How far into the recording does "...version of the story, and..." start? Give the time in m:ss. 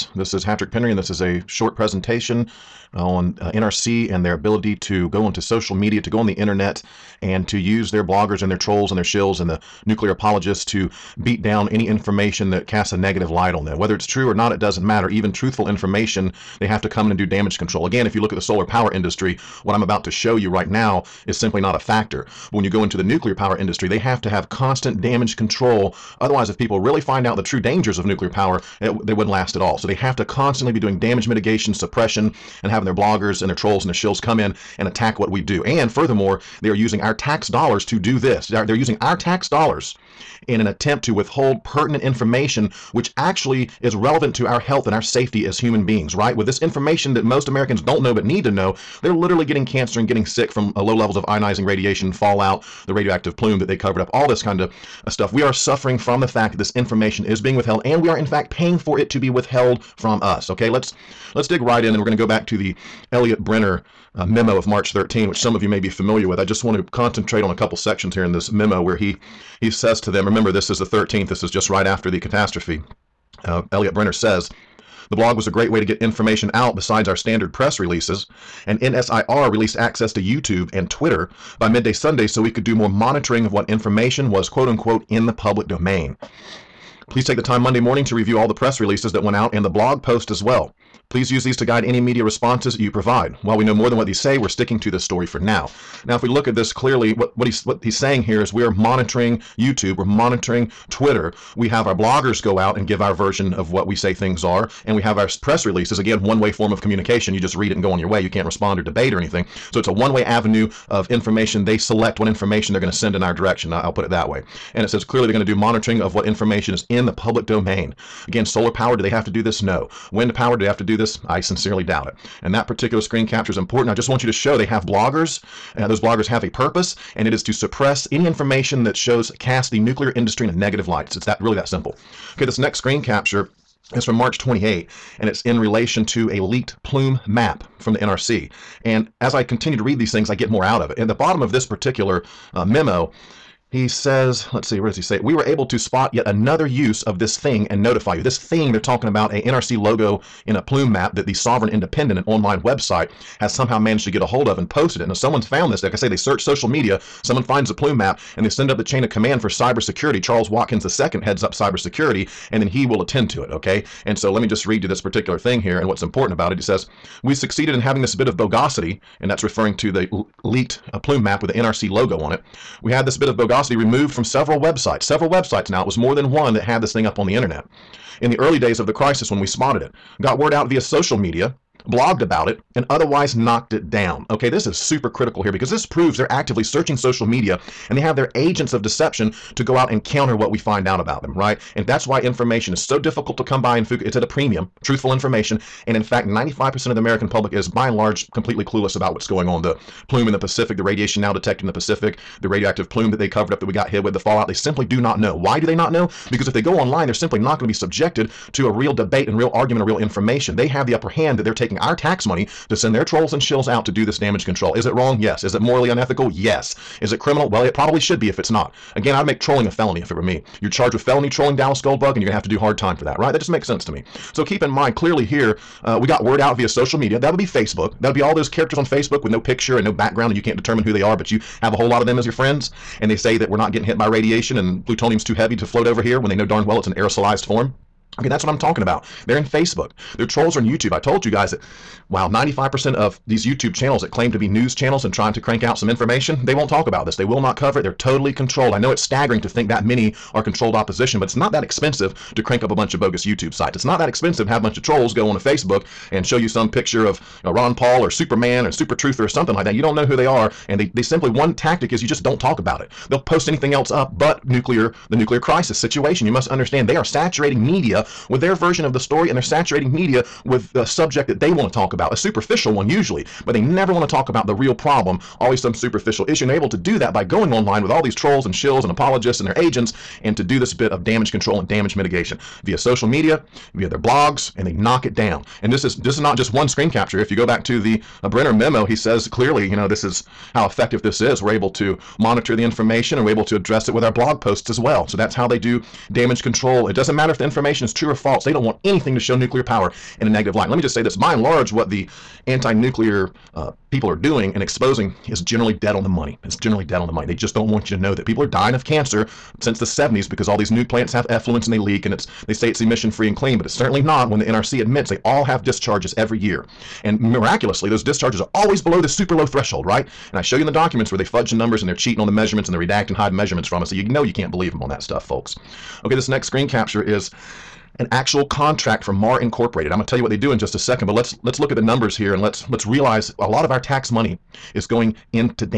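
4:28.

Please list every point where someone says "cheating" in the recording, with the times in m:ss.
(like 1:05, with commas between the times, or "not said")
5:21.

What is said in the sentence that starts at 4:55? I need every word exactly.
So that's how they do damage control.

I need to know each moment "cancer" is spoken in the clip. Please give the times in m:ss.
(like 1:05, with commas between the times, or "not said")
0:49, 5:08.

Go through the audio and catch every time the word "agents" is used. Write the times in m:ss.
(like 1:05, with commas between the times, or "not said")
3:08, 4:39.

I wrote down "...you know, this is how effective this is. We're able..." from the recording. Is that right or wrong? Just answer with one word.
right.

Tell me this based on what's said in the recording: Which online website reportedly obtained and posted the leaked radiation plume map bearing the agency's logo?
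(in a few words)
Sovereign Independent.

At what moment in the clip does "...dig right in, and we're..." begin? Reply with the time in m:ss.
1:01.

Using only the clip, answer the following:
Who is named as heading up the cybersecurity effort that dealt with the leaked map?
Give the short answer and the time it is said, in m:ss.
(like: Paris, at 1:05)
Charles Watkins II, at 2:40.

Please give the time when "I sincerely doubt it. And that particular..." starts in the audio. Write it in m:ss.
2:01.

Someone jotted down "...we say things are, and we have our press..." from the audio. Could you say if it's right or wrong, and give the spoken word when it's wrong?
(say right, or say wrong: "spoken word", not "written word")
right.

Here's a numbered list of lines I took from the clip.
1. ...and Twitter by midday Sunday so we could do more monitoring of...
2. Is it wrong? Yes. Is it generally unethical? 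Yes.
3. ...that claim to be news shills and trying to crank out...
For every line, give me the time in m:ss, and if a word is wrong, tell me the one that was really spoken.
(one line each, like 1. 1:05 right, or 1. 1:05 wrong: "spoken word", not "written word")
1. 1:20 right
2. 3:34 wrong: "morally", not "generally"
3. 4:04 wrong: "channels", not "shills".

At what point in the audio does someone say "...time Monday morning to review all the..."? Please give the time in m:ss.
1:27.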